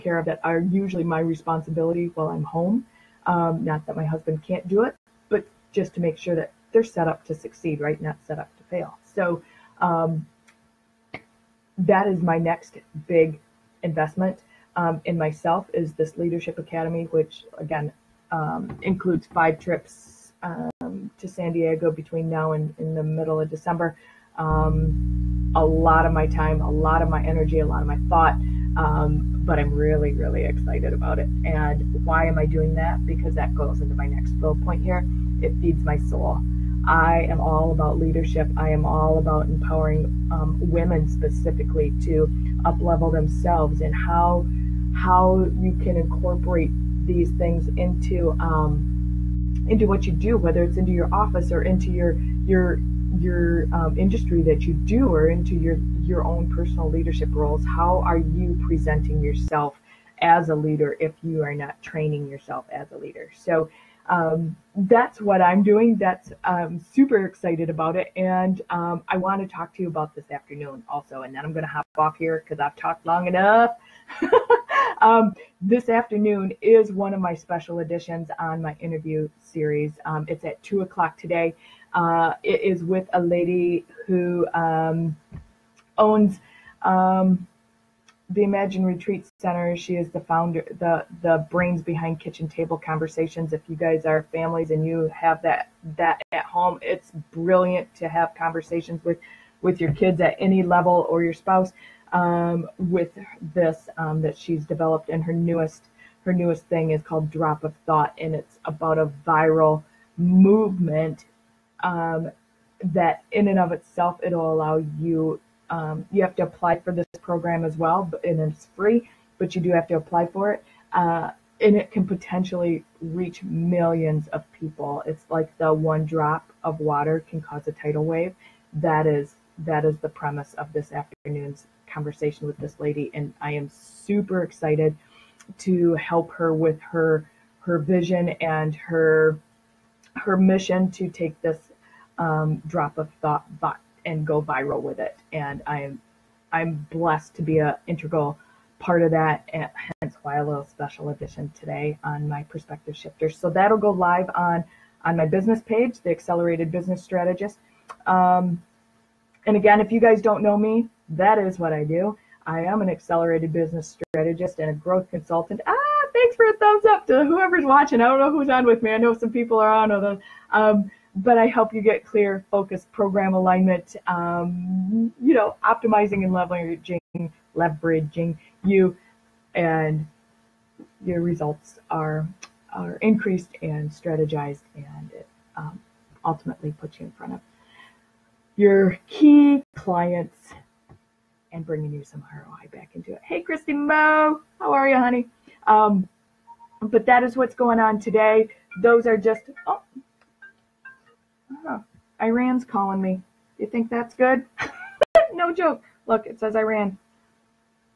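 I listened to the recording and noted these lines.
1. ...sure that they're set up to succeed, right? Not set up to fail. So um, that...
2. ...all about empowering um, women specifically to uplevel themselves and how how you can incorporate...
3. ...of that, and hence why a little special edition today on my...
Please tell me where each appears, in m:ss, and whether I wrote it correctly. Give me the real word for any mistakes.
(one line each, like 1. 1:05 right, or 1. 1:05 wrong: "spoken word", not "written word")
1. 0:06 right
2. 0:38 right
3. 2:29 right.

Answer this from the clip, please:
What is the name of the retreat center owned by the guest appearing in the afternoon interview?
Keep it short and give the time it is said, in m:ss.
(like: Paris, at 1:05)
Imagine Retreat Center, at 1:28.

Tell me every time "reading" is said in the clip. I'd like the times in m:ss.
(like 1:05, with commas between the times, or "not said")
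not said.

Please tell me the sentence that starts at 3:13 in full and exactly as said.
Hey, Christy Mo, how are you, honey?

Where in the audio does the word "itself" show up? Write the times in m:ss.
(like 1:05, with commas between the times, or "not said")
1:53.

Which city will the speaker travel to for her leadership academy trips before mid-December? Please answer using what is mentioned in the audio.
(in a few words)
San Diego.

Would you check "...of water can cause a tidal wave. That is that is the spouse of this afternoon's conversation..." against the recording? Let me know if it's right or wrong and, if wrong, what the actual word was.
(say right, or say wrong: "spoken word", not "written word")
wrong: "premise", not "spouse".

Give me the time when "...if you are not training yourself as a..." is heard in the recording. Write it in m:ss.
1:00.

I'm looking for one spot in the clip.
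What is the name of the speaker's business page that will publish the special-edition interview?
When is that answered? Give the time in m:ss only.
2:36.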